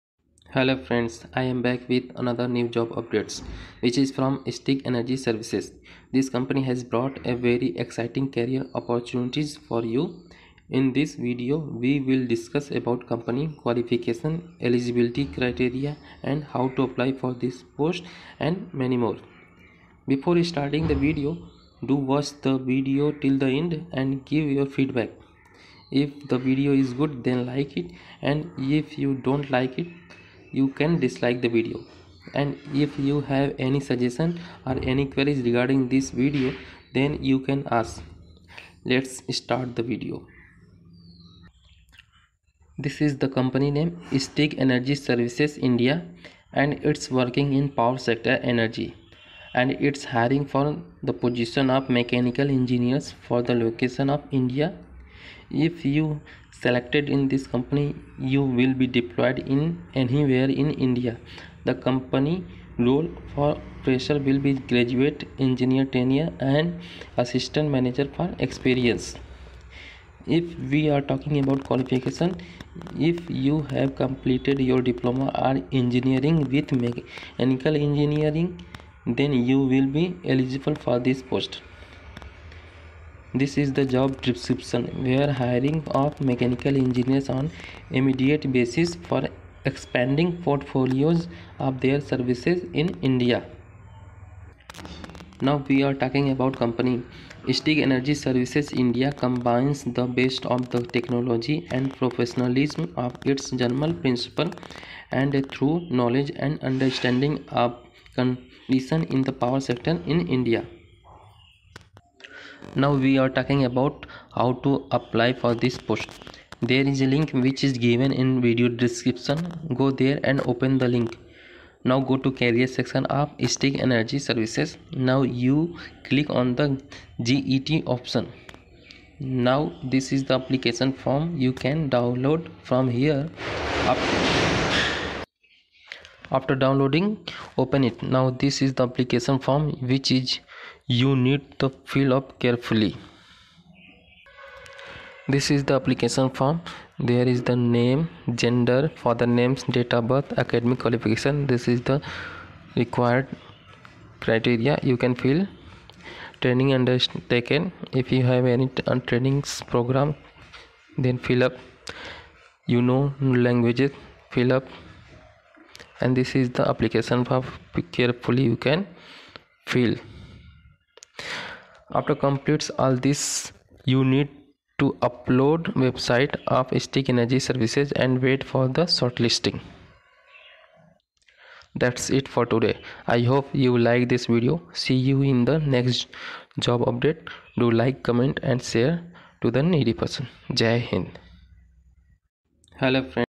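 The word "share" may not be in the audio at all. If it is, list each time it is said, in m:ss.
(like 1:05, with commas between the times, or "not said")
3:08.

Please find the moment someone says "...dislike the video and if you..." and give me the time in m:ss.
0:30.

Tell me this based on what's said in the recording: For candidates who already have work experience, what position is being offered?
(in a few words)
Assistant manager.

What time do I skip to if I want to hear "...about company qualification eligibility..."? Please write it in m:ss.
0:12.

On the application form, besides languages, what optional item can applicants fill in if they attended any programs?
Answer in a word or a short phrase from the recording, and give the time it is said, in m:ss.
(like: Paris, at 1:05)
Training undertaken, at 2:36.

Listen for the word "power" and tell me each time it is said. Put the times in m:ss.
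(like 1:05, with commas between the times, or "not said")
0:47, 1:49.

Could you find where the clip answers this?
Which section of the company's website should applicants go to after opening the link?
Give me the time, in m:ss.
2:02.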